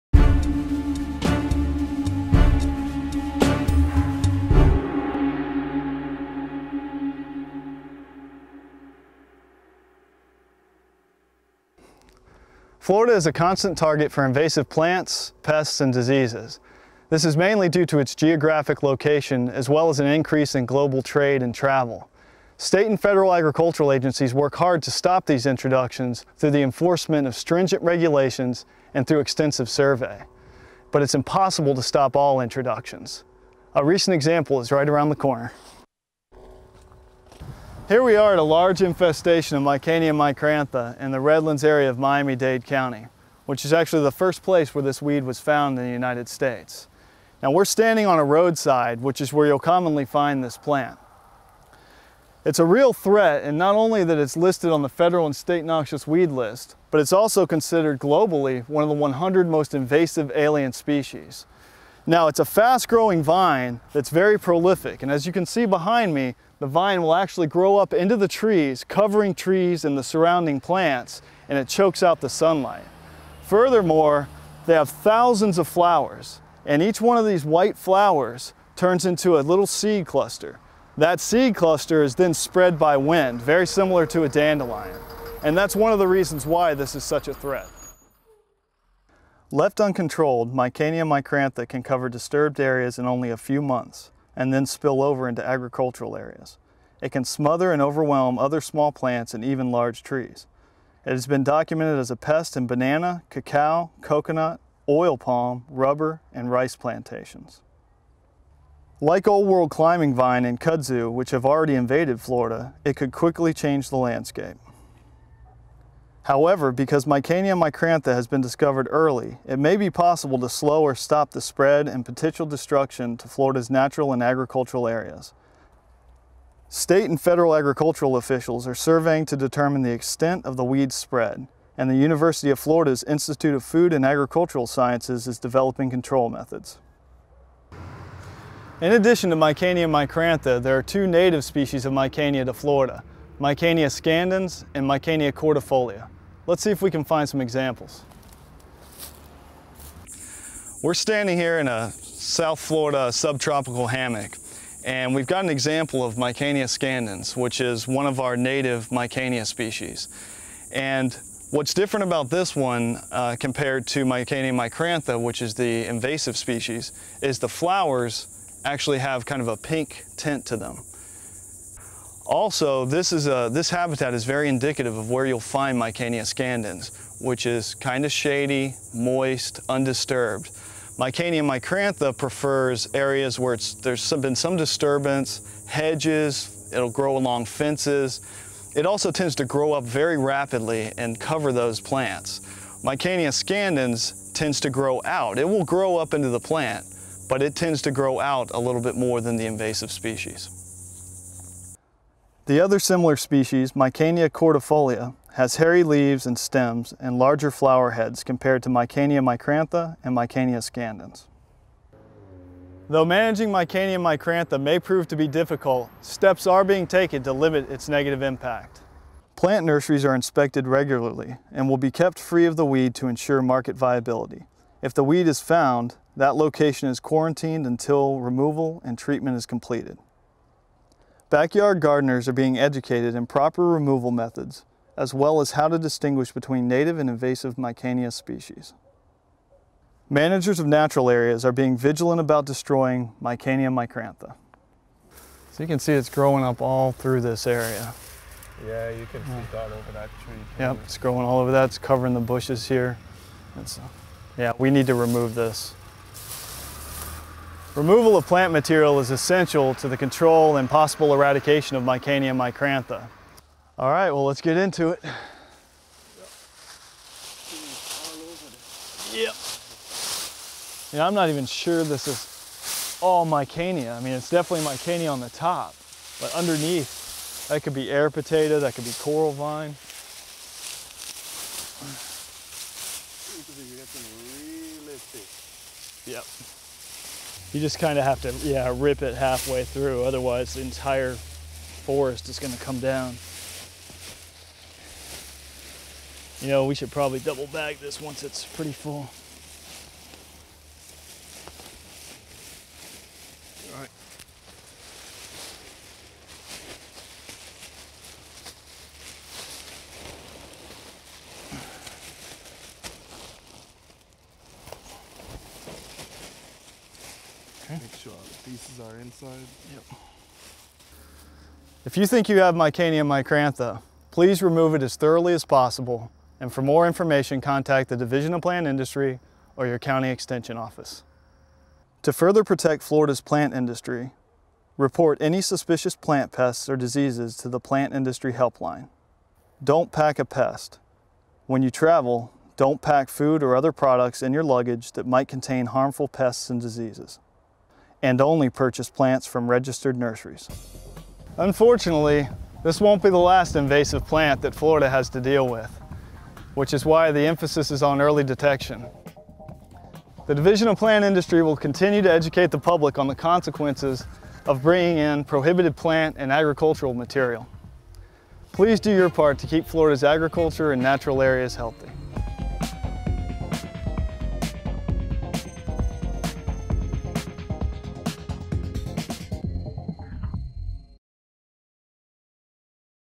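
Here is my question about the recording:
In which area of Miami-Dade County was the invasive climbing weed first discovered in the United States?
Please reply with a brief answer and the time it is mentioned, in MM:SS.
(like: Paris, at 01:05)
Redlands, at 00:41.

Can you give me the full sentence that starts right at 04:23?
All right, well, let's get into it.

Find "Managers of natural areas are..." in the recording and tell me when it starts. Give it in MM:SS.
04:00.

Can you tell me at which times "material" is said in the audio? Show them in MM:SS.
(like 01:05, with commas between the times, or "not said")
04:18, 06:06.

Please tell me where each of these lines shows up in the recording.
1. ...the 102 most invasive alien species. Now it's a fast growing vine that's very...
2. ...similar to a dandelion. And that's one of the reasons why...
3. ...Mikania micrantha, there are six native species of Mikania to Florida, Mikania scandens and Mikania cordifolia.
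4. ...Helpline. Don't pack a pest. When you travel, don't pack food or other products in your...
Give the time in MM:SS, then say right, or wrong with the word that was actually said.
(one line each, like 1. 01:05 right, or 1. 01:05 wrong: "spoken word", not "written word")
1. 00:58 wrong: "100", not "102"
2. 01:23 right
3. 02:19 wrong: "two", not "six"
4. 05:38 right.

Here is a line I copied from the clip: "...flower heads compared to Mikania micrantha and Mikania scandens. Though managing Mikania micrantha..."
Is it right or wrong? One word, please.
right.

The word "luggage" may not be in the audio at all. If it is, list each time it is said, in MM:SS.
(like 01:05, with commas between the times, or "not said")
05:44.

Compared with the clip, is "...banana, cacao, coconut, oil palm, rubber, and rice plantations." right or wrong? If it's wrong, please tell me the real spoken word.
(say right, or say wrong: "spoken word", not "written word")
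right.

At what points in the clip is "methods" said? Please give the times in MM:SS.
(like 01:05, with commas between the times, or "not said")
02:16, 03:54.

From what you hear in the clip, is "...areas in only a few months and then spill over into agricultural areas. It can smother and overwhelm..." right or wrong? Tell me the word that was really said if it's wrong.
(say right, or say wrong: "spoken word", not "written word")
right.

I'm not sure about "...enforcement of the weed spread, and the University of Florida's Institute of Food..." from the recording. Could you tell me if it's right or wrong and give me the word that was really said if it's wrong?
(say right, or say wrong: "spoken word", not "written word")
wrong: "extent", not "enforcement".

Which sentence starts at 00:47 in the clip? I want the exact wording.
Now we're standing on a roadside, which is where you'll commonly find this plant.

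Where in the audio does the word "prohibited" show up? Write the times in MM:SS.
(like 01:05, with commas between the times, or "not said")
06:05.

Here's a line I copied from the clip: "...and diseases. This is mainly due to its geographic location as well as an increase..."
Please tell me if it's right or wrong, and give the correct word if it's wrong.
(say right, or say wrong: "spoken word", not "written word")
right.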